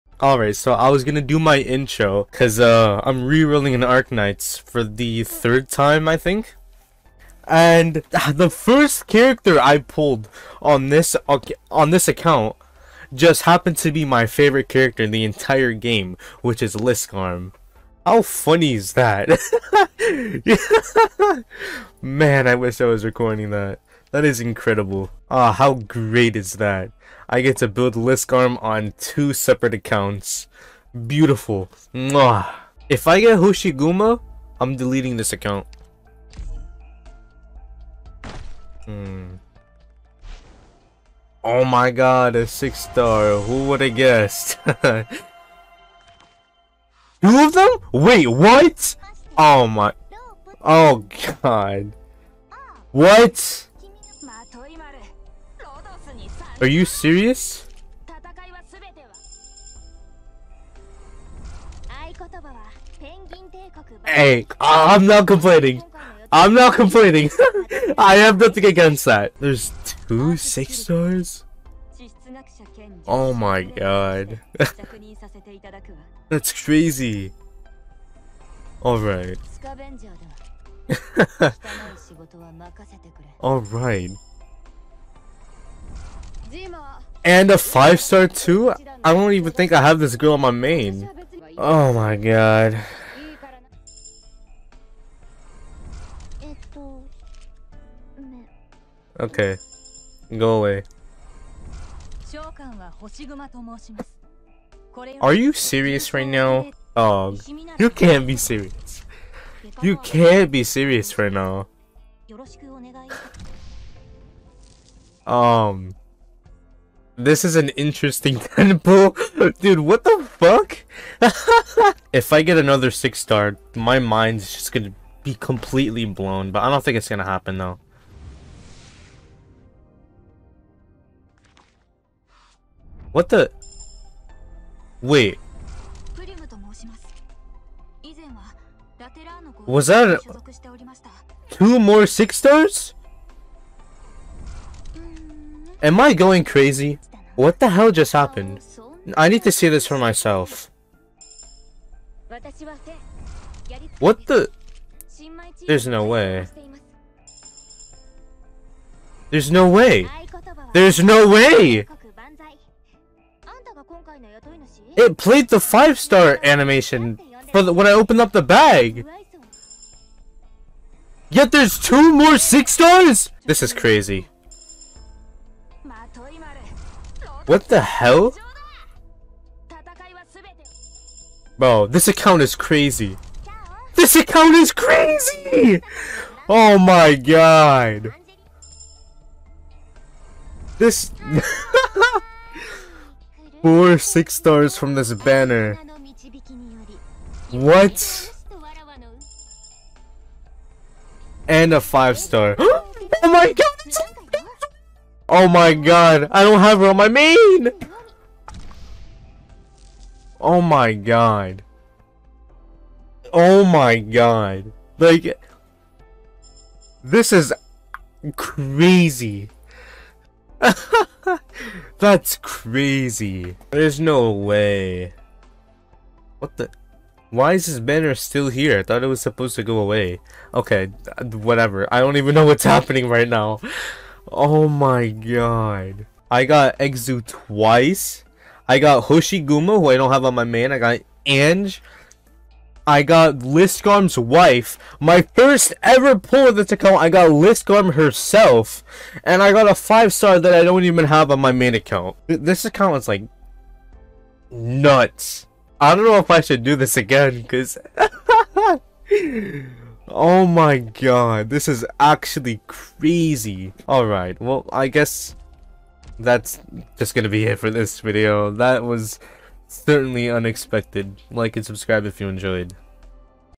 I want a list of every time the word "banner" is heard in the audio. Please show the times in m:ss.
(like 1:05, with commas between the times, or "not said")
3:15, 3:47.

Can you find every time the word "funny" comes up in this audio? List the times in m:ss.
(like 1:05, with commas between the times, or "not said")
0:18.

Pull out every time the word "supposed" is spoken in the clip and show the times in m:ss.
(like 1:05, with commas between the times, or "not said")
3:49.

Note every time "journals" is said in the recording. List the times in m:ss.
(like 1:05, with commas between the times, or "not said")
not said.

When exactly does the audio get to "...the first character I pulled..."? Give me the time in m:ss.
0:08.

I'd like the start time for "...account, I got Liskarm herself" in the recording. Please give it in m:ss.
4:06.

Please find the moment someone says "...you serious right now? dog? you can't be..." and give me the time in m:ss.
1:45.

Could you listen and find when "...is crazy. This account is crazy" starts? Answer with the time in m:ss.
3:02.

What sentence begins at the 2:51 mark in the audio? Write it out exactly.
Yet there's two more 6 stars?!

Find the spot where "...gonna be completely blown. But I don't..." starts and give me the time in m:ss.
2:04.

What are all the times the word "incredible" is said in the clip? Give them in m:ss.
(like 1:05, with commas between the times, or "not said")
0:24.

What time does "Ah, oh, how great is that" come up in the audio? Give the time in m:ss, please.
0:25.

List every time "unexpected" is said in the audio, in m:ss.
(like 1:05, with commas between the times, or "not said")
4:30.